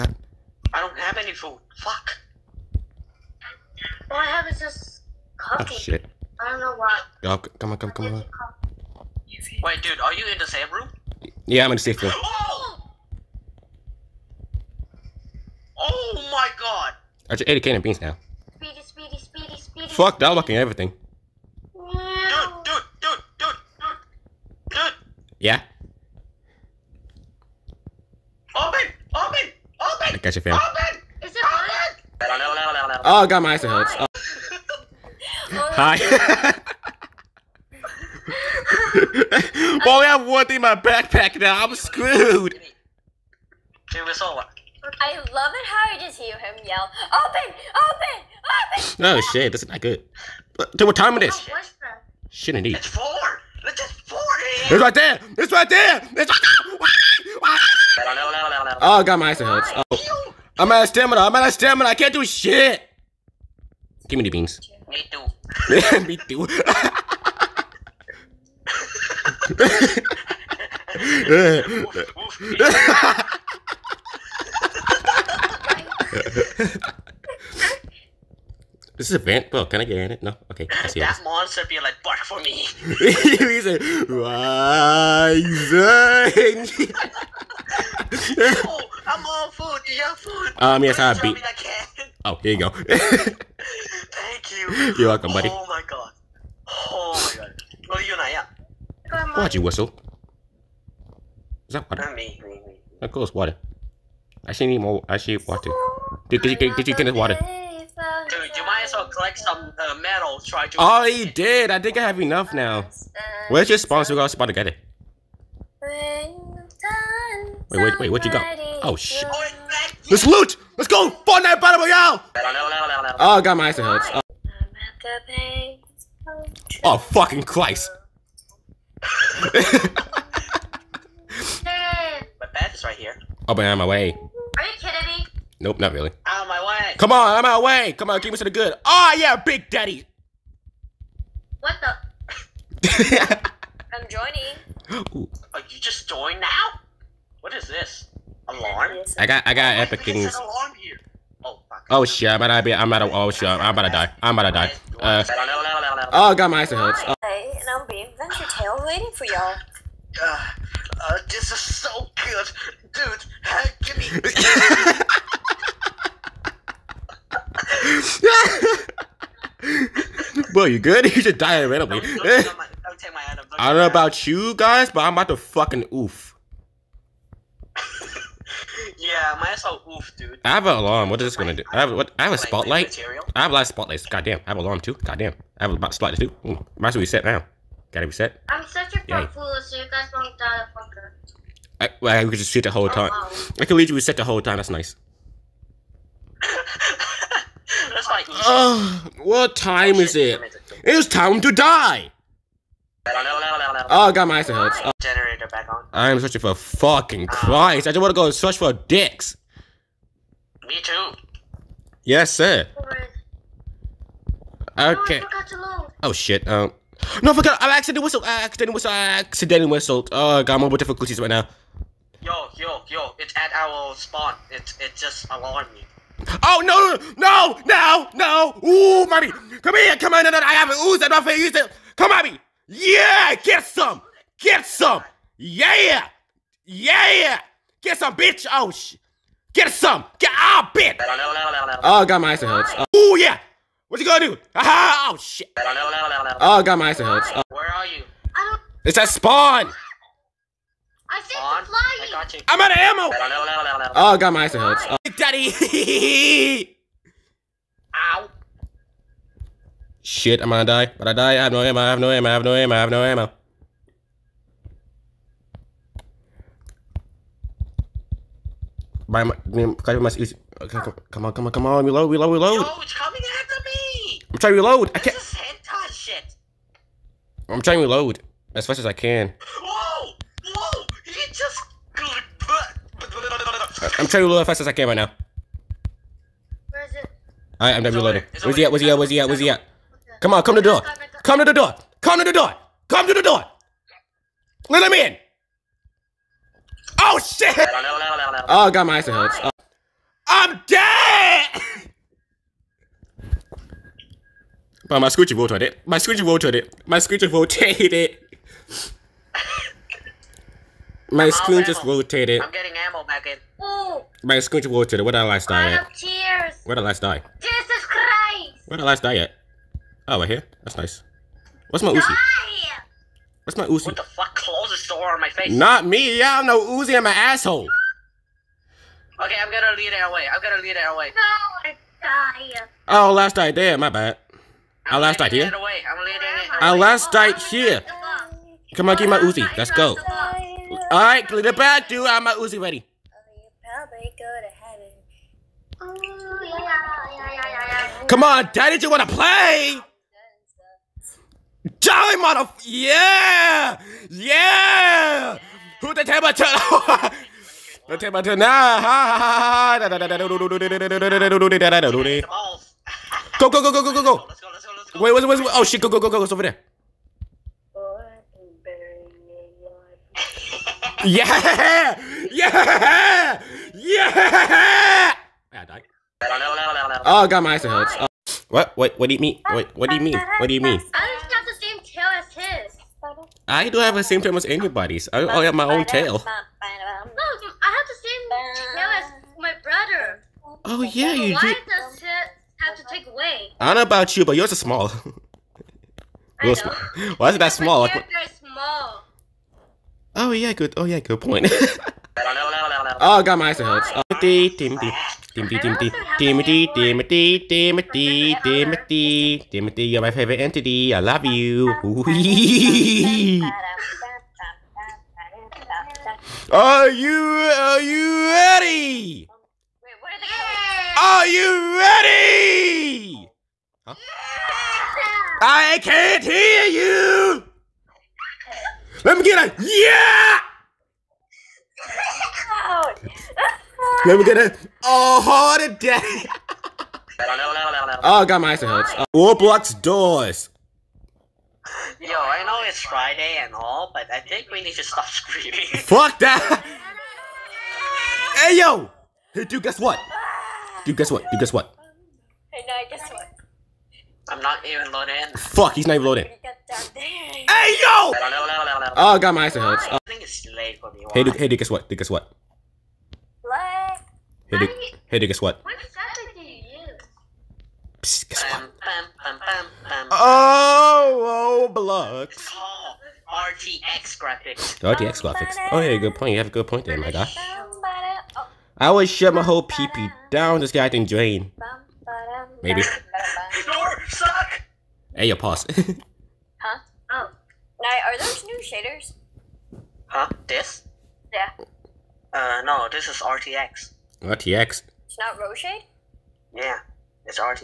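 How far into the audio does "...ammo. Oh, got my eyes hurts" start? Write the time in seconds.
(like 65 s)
252 s.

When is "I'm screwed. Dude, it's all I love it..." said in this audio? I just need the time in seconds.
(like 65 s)
41 s.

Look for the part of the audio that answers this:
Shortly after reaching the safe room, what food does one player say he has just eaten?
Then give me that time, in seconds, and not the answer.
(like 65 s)
17 s.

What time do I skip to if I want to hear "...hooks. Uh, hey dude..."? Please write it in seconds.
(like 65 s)
459 s.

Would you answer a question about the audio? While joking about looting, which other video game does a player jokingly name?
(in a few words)
Fortnite battle royale.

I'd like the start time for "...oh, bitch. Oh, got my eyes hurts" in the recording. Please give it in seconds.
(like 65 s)
240 s.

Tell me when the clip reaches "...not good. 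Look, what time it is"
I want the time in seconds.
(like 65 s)
49 s.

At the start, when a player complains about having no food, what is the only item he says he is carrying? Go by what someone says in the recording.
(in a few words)
coffee.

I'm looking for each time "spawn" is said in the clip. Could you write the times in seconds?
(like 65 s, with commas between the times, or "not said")
223 s, 249 s.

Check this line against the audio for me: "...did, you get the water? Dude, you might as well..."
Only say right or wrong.
right.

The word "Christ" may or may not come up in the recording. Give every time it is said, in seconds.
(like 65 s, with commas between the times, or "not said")
127 s, 207 s, 317 s.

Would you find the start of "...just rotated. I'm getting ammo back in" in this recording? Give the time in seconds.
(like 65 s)
311 s.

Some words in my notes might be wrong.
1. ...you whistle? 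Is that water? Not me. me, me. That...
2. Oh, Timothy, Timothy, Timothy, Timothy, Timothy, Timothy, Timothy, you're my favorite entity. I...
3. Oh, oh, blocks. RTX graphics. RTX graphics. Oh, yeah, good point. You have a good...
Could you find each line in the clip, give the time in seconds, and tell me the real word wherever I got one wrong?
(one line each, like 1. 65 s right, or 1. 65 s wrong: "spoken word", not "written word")
1. 99 s right
2. 403 s right
3. 470 s right.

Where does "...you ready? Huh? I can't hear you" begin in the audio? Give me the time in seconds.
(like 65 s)
421 s.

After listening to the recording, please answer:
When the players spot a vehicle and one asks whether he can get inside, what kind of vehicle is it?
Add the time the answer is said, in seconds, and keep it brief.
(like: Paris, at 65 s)
van, at 79 s.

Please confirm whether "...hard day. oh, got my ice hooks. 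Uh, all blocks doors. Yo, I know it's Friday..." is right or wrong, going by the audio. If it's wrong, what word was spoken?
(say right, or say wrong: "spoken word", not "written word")
right.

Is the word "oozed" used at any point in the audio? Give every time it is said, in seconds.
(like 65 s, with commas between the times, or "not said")
230 s.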